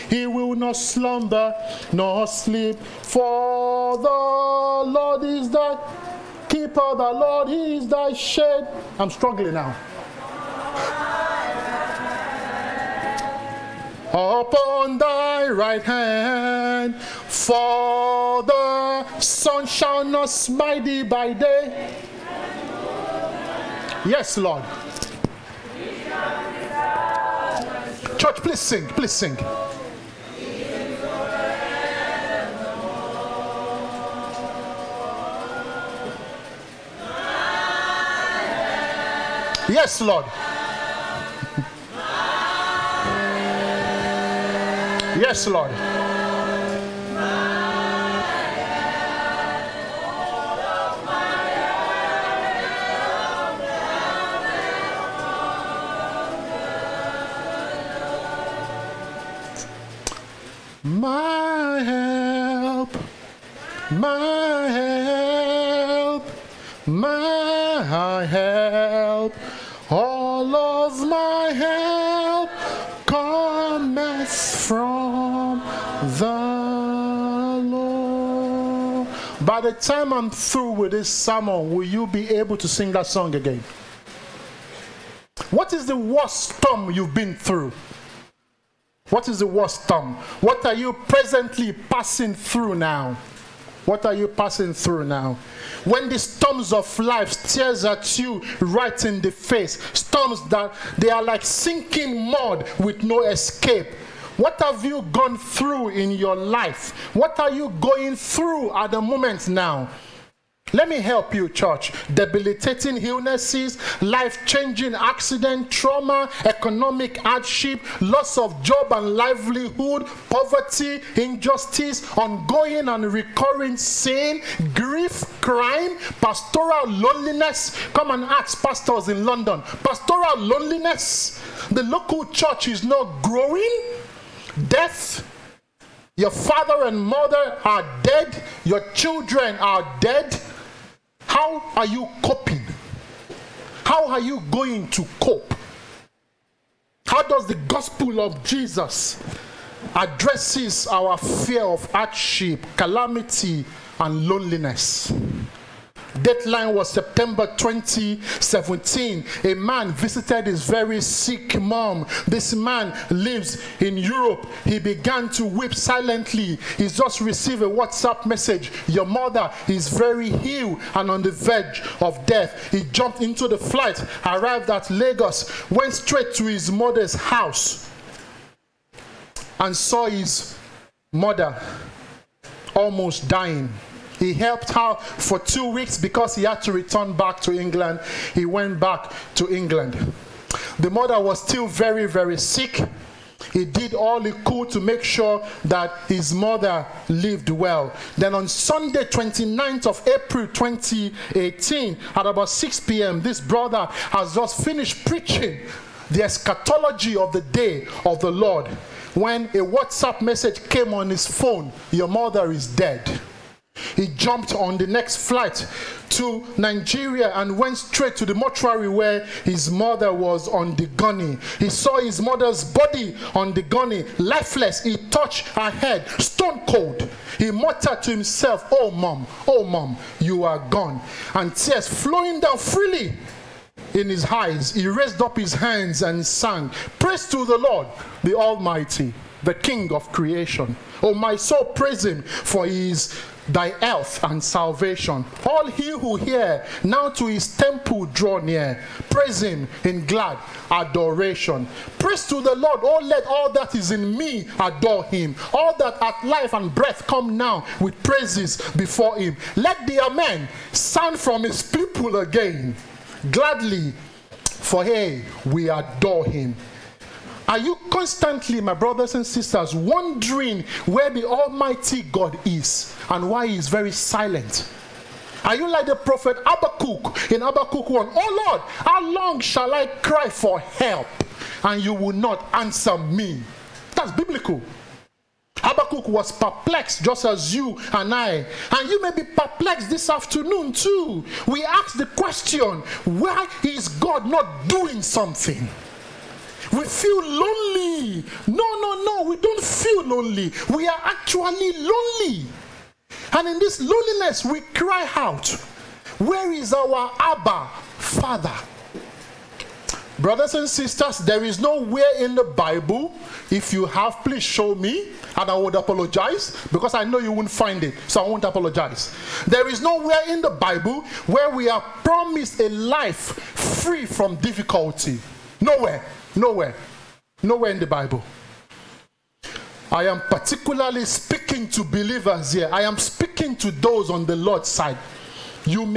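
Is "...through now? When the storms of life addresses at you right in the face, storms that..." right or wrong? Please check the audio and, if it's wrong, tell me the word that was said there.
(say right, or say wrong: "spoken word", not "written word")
wrong: "stares", not "addresses".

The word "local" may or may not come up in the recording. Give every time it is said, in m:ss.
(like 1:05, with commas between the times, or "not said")
2:11.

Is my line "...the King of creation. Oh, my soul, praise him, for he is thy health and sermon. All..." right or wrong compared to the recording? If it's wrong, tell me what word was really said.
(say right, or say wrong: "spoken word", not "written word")
wrong: "salvation", not "sermon".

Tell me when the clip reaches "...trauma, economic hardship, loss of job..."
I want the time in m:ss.
1:55.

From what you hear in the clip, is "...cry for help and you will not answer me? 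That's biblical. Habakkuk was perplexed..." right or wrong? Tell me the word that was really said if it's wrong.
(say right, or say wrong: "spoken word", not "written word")
right.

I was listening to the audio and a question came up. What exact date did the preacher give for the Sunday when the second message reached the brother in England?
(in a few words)
29th of April 2018.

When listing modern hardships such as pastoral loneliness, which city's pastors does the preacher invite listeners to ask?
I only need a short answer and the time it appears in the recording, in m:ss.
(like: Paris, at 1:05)
London, at 2:09.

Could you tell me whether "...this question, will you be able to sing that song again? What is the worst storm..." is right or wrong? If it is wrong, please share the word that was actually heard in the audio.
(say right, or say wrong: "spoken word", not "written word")
wrong: "sermon", not "question".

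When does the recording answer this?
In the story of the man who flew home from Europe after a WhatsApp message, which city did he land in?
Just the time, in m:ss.
2:54.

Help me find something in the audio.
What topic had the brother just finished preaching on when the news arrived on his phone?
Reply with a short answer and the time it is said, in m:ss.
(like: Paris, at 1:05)
The day of the Lord, at 3:27.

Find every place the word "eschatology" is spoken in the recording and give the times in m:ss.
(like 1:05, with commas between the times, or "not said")
3:26.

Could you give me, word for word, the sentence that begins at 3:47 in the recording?
He muttered to himself, Oh, mom, oh, mom, you are gone.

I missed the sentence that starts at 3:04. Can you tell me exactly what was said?
He helped her for two weeks because he had to return back to England.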